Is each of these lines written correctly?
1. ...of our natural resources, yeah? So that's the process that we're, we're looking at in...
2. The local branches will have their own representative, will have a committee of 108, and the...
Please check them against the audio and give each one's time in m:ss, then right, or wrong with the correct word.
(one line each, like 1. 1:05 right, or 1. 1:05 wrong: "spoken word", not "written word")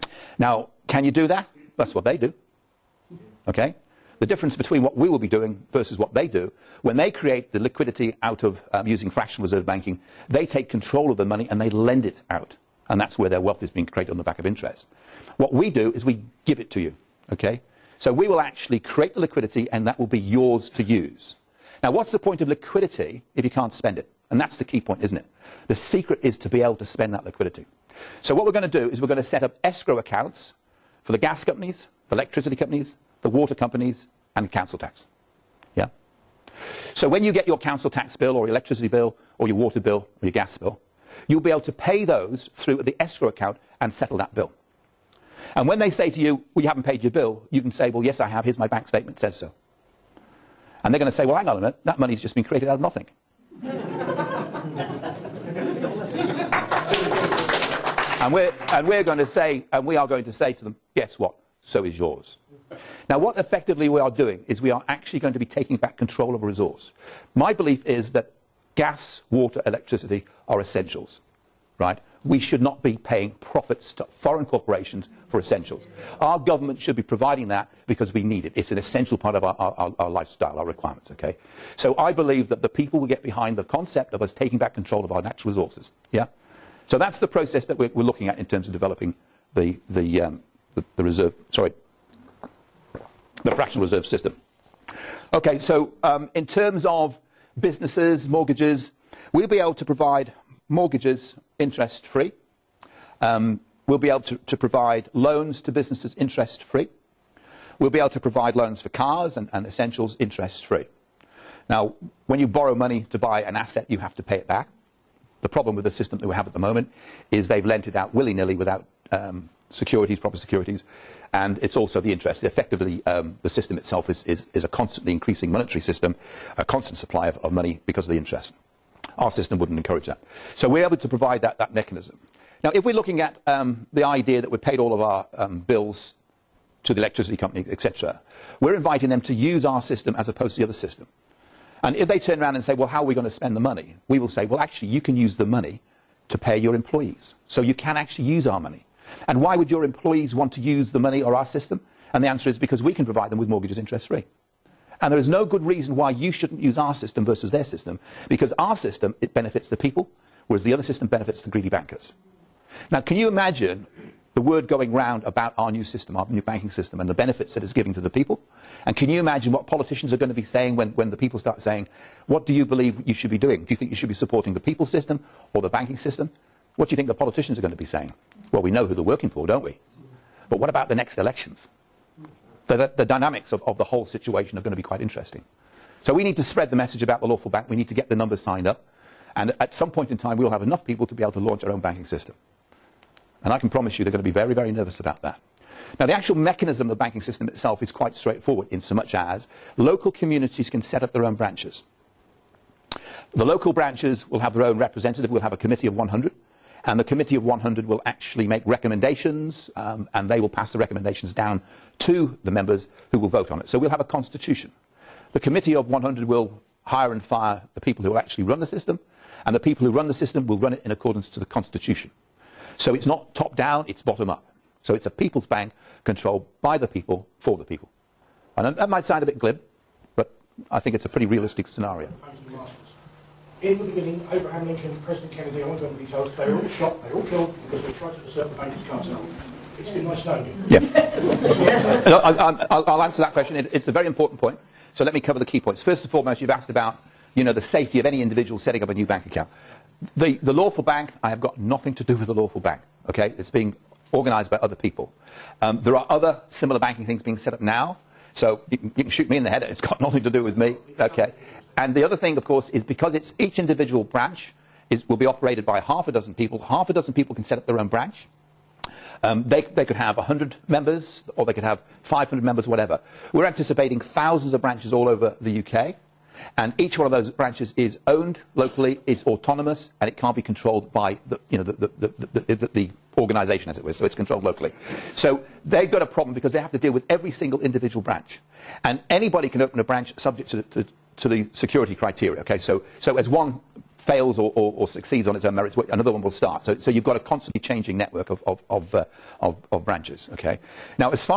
1. 1:25 right
2. 3:23 wrong: "100", not "108".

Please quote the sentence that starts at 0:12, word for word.
And that's where their wealth is being created on the back of interest.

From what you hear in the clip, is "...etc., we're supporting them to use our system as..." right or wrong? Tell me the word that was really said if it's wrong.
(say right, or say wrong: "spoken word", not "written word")
wrong: "inviting", not "supporting".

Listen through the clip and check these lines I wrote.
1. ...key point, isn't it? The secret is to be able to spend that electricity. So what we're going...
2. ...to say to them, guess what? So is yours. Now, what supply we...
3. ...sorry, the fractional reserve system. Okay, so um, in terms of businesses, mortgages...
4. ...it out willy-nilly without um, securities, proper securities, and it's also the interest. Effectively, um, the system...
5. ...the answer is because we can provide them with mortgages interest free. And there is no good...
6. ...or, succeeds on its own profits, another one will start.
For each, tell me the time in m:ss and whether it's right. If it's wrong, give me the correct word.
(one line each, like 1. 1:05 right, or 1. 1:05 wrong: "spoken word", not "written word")
1. 0:24 wrong: "liquidity", not "electricity"
2. 1:00 wrong: "effectively", not "supply"
3. 1:31 right
4. 1:57 right
5. 2:32 right
6. 4:54 wrong: "merits", not "profits".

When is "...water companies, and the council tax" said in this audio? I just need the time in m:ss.
0:33.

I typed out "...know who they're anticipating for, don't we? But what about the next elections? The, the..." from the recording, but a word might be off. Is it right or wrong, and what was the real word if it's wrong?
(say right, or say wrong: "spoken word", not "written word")
wrong: "working", not "anticipating".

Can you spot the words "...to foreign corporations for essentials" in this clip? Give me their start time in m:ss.
1:13.